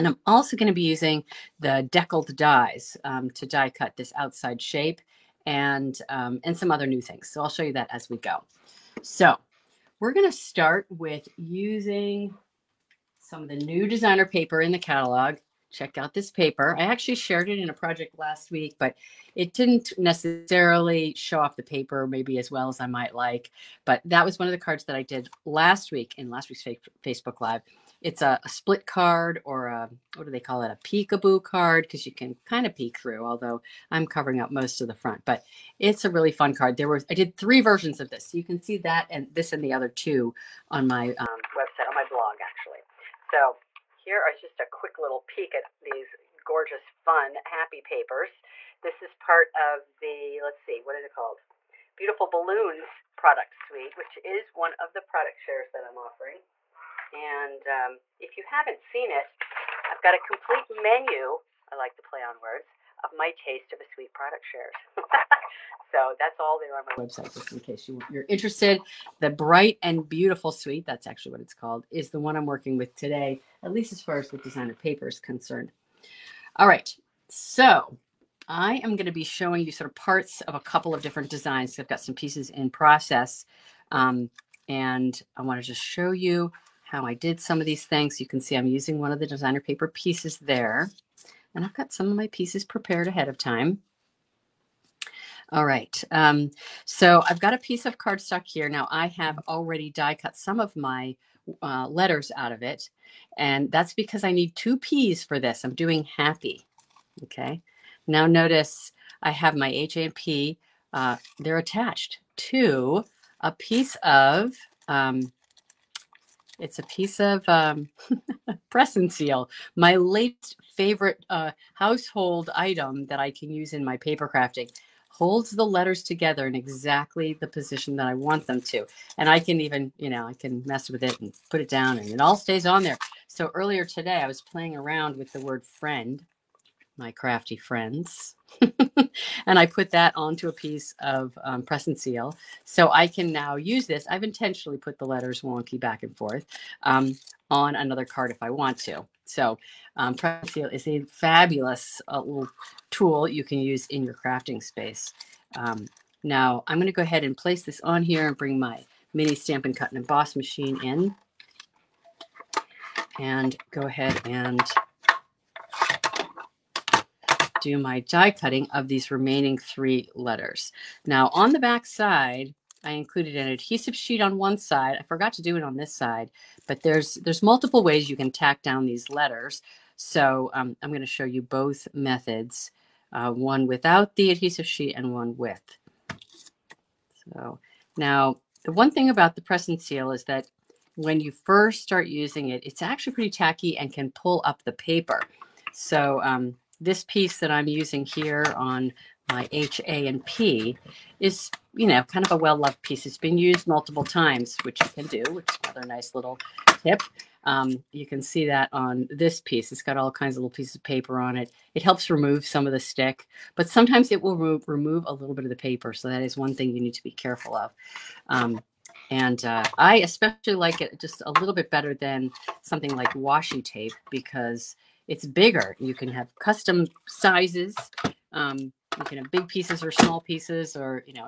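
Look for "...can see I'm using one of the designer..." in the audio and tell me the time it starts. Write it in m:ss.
1:28.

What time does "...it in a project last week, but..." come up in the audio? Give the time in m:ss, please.
0:17.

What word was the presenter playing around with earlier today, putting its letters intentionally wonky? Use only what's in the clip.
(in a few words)
friend.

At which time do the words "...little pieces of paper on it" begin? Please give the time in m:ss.
3:30.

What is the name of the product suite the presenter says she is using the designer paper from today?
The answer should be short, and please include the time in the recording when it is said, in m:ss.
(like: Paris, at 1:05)
Bright and Beautiful Suite, at 1:09.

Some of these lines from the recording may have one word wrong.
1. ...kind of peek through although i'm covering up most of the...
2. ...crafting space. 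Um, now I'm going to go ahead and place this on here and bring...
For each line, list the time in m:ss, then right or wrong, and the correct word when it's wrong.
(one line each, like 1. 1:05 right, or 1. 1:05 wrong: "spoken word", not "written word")
1. 0:32 right
2. 2:34 right.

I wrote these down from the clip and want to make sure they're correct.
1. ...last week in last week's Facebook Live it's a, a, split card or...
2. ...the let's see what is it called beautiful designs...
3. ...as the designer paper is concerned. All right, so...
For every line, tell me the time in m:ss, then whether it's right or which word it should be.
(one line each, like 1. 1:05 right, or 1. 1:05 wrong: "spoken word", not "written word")
1. 0:25 right
2. 0:49 wrong: "balloons", not "designs"
3. 1:14 right.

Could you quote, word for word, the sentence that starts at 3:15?
So um, this piece that I'm using here on my H, A, and P is, you know, kind of a well-loved piece.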